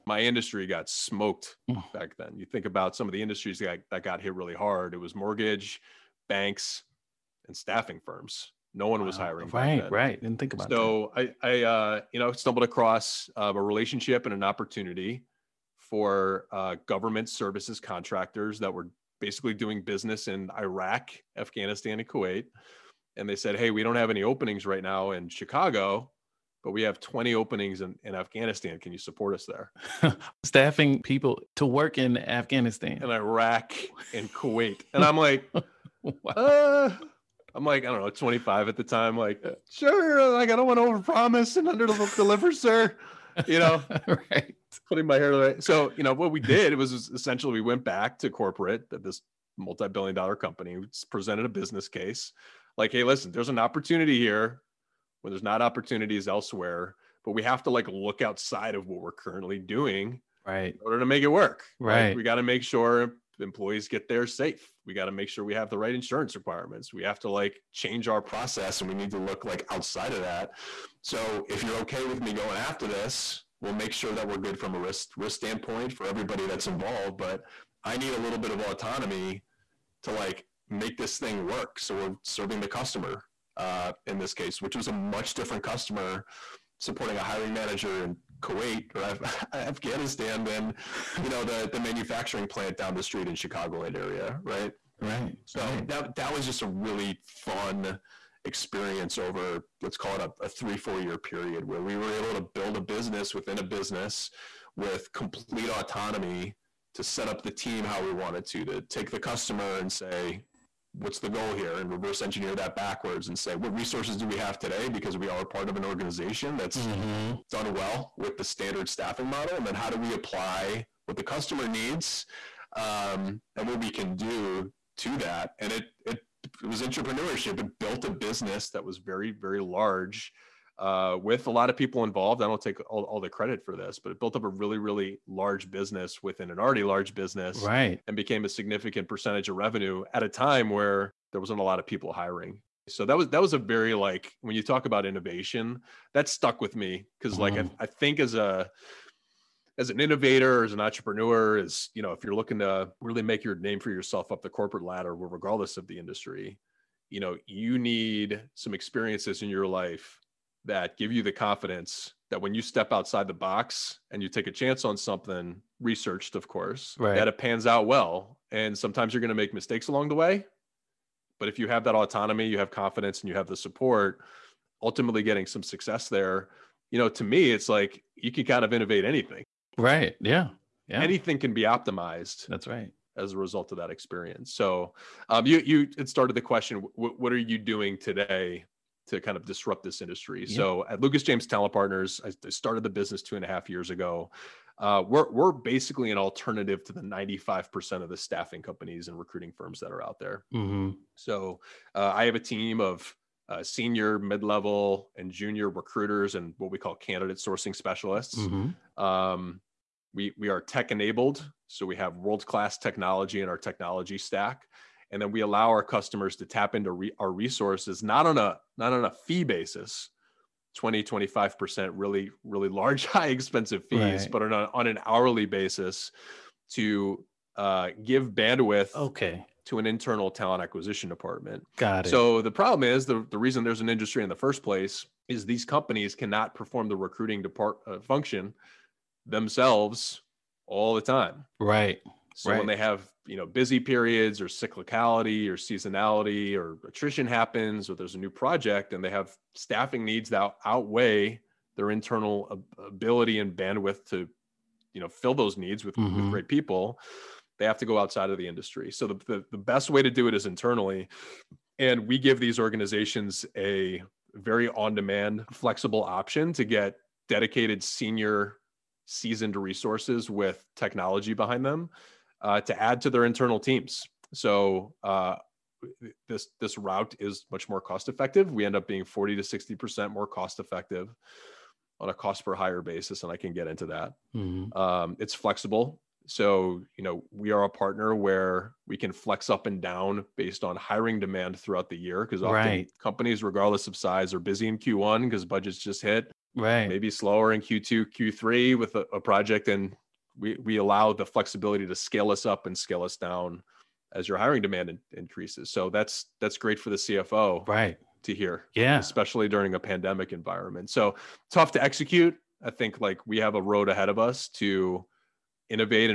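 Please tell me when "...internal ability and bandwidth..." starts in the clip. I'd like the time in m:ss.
4:11.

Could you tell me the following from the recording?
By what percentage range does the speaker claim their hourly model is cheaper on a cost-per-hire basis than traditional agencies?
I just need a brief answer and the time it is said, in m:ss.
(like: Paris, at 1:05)
40 to 60 percent, at 4:39.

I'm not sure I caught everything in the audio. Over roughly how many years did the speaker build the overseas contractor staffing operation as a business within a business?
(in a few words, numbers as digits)
3 to 4 years.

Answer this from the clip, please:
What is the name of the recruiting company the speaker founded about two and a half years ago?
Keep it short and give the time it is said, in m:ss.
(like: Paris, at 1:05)
Lucas James Talent Partners, at 3:11.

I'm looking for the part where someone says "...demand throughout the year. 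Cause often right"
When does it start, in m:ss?
4:51.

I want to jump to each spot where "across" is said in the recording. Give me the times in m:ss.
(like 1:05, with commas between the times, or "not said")
0:12.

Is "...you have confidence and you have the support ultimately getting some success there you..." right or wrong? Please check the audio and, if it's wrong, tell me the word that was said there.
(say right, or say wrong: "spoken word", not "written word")
right.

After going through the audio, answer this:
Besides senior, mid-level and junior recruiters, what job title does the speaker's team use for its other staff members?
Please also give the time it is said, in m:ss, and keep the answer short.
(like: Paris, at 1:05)
candidate sourcing specialists, at 3:26.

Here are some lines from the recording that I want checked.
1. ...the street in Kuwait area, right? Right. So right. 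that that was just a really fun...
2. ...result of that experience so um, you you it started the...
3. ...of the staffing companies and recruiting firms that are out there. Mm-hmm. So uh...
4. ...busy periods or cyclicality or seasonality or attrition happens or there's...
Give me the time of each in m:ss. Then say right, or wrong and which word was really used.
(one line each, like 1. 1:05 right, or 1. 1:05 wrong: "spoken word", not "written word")
1. 1:32 wrong: "Chicagoland", not "Kuwait"
2. 3:03 right
3. 3:18 right
4. 4:03 right.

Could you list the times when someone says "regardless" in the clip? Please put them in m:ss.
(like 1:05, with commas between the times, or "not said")
2:35, 4:53.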